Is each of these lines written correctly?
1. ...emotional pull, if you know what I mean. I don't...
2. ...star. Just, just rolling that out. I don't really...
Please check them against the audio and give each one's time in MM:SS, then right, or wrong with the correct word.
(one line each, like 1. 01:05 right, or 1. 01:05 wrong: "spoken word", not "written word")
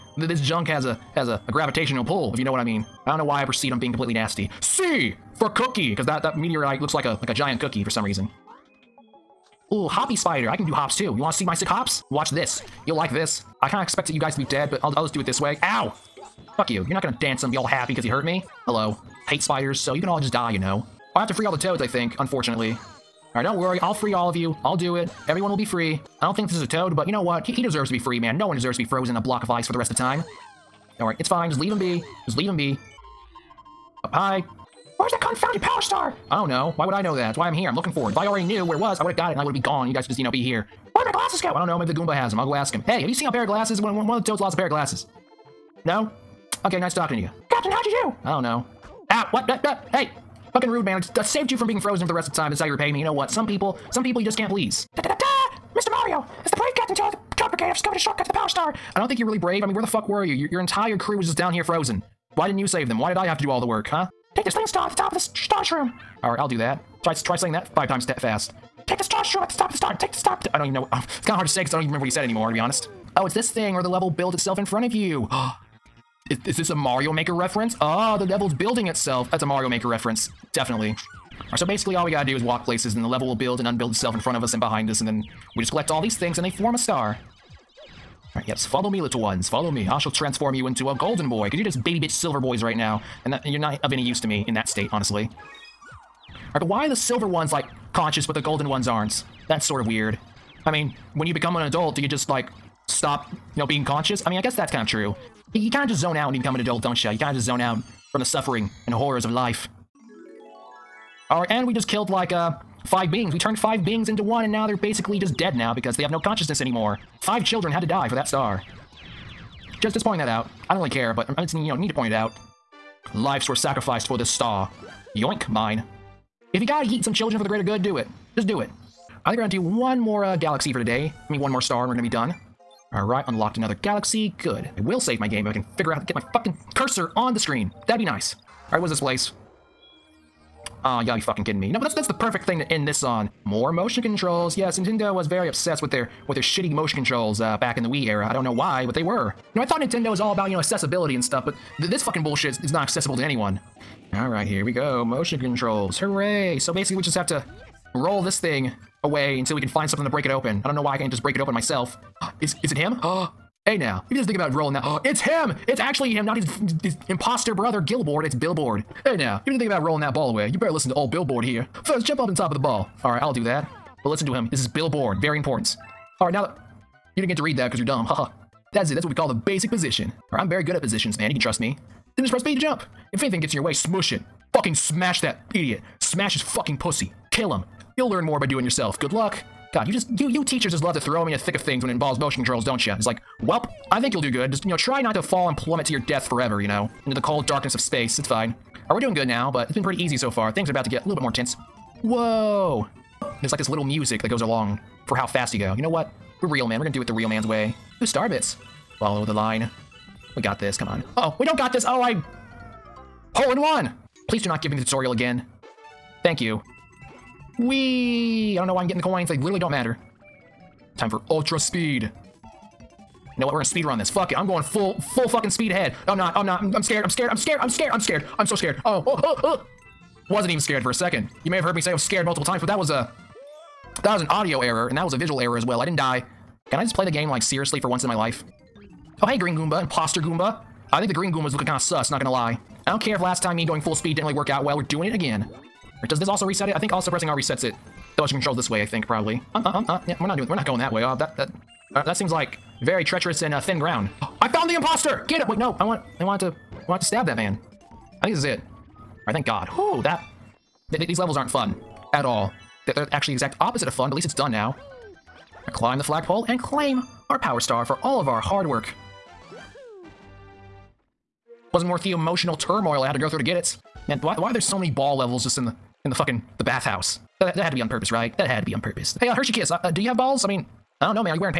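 1. 00:01 wrong: "gravitational", not "emotional"
2. 01:58 wrong: "pointing", not "rolling".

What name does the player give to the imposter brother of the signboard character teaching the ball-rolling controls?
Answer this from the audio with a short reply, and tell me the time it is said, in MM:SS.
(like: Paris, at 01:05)
Gilboard, at 02:47.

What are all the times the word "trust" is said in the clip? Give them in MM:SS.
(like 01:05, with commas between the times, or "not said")
03:01.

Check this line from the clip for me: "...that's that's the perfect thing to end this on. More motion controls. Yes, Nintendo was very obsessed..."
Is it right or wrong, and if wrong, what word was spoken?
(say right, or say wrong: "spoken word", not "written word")
right.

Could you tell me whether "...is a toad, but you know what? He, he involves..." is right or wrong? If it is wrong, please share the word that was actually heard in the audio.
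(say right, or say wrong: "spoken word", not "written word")
wrong: "deserves", not "involves".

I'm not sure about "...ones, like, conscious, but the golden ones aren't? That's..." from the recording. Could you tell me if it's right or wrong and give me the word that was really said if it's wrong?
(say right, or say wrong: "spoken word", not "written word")
right.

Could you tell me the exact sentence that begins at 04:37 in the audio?
That, that had to be on purpose, right?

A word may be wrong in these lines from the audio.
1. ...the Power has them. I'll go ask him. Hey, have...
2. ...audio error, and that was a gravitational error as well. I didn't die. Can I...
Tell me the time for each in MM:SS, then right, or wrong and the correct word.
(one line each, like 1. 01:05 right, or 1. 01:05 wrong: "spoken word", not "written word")
1. 00:41 wrong: "Goomba", not "Power"
2. 03:54 wrong: "visual", not "gravitational".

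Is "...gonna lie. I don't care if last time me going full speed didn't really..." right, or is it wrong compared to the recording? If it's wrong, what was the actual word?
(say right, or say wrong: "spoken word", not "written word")
right.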